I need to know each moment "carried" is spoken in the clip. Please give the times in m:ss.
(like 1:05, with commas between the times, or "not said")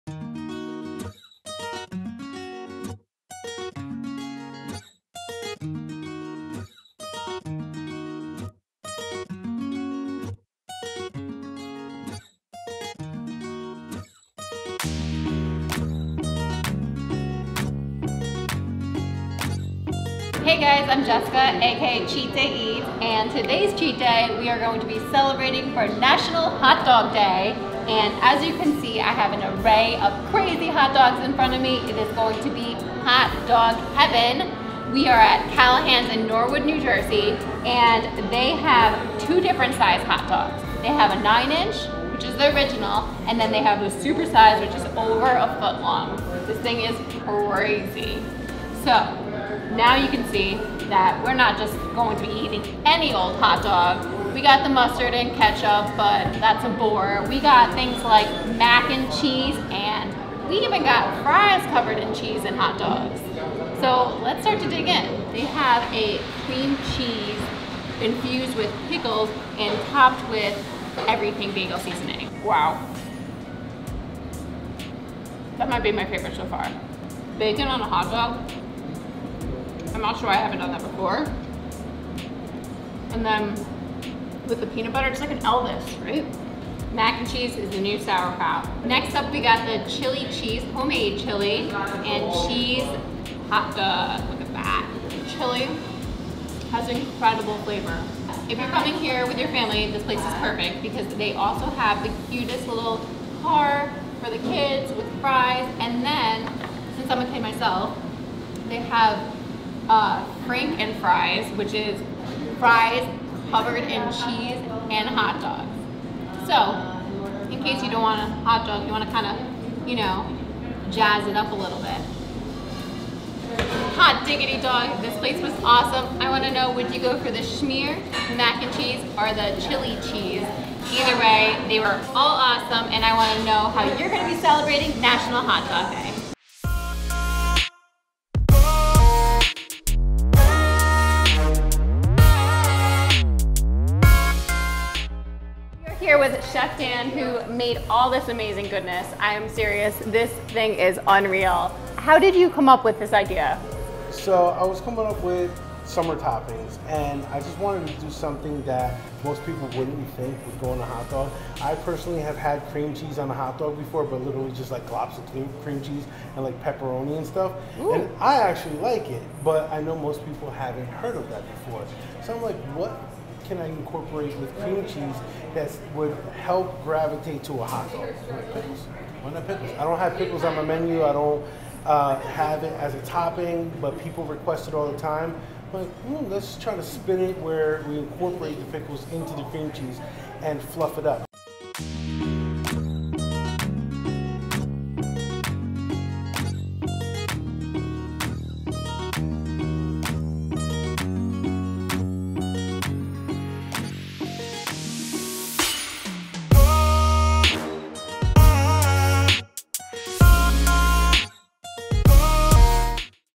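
not said.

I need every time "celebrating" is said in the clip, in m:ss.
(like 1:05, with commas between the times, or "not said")
0:25, 2:14.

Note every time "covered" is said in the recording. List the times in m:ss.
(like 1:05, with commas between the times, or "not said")
1:01, 1:53.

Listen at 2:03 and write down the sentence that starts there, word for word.
Hot diggity dog, this place was awesome.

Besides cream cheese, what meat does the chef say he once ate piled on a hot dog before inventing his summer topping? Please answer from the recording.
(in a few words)
Pepperoni.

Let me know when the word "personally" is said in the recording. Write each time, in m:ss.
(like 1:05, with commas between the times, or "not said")
2:41.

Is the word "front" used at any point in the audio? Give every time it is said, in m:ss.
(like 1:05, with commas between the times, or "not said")
0:31.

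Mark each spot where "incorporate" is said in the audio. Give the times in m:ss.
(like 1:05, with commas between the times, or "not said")
2:53, 3:07.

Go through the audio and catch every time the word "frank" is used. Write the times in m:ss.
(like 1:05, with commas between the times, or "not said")
1:50.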